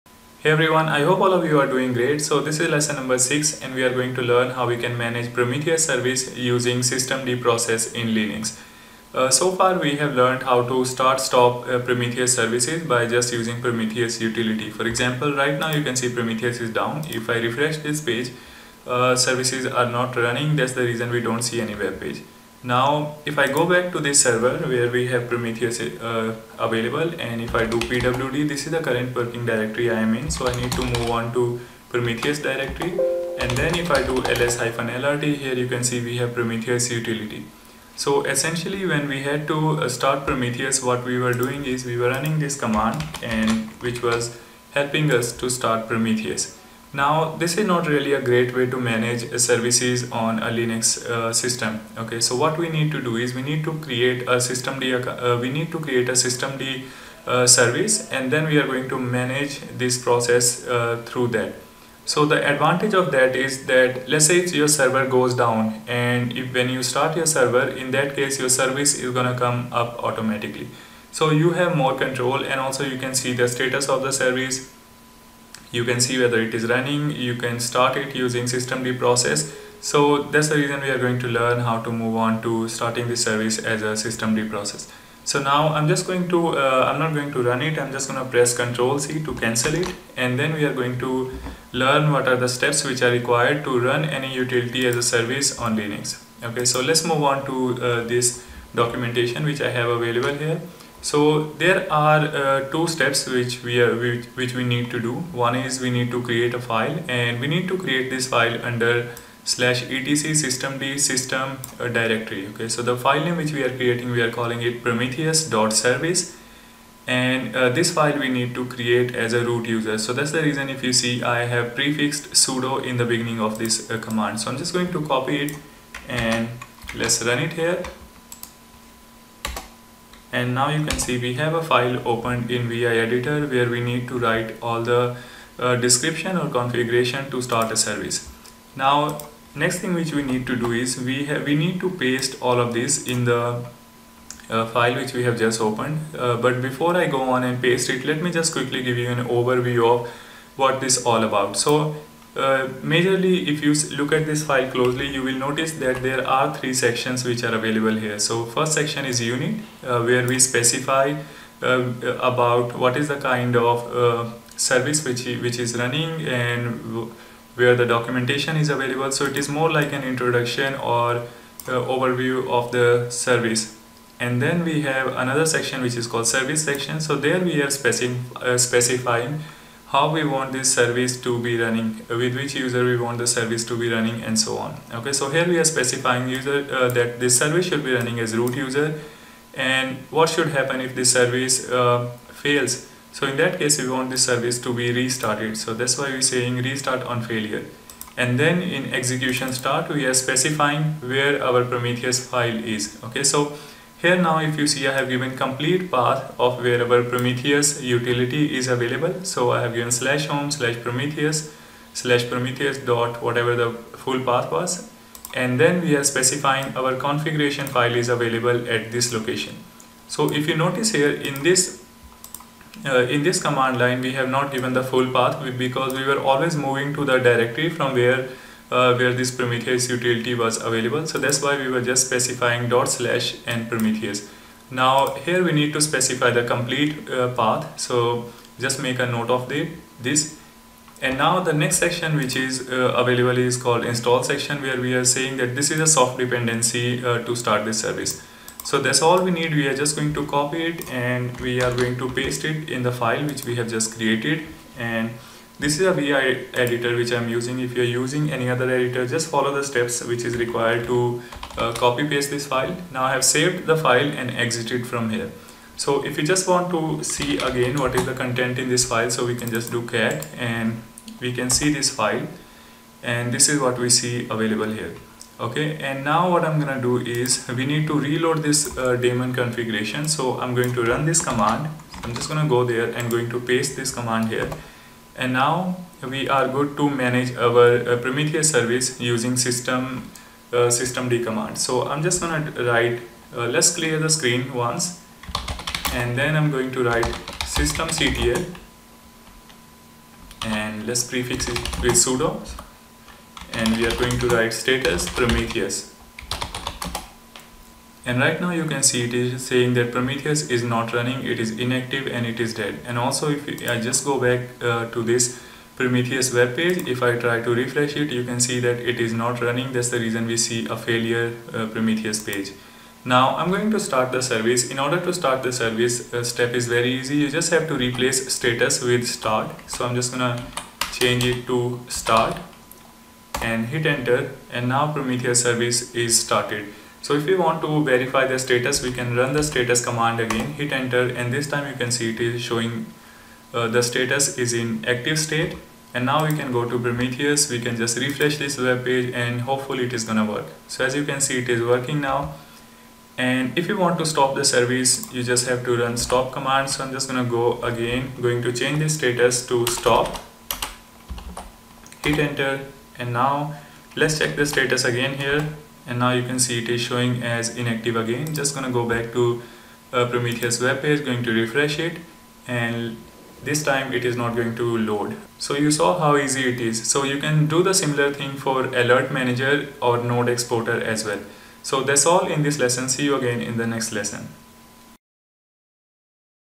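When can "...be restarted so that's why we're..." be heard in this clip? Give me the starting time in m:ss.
3:14.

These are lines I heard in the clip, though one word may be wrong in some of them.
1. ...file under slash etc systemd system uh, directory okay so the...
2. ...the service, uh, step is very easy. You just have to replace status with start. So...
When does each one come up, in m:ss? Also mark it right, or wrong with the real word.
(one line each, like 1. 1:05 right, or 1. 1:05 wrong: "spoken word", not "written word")
1. 1:48 right
2. 5:25 right.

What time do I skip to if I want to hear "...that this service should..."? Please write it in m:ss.
3:06.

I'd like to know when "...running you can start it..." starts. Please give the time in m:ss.
1:16.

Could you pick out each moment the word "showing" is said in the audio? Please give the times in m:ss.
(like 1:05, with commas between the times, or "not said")
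5:42, 6:06.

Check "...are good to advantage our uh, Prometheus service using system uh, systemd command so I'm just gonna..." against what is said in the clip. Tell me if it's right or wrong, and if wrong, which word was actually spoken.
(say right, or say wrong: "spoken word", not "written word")
wrong: "manage", not "advantage".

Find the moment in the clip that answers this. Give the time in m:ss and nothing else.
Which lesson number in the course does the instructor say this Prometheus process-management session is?
0:02.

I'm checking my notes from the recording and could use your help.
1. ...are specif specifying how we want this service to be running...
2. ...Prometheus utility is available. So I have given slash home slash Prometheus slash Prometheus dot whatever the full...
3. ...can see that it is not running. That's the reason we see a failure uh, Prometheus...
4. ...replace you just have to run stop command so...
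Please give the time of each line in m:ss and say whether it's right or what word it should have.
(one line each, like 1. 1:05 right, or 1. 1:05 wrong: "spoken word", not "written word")
1. 2:57 right
2. 3:27 right
3. 5:18 right
4. 5:54 wrong: "service", not "replace".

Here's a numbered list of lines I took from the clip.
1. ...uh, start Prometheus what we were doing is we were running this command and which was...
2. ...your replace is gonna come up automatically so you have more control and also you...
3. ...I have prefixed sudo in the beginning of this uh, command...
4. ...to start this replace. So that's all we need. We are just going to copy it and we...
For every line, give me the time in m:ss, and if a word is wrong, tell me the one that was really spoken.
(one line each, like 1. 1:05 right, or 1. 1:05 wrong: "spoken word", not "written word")
1. 0:39 right
2. 1:08 wrong: "service", not "replace"
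3. 2:01 right
4. 4:07 wrong: "service", not "replace".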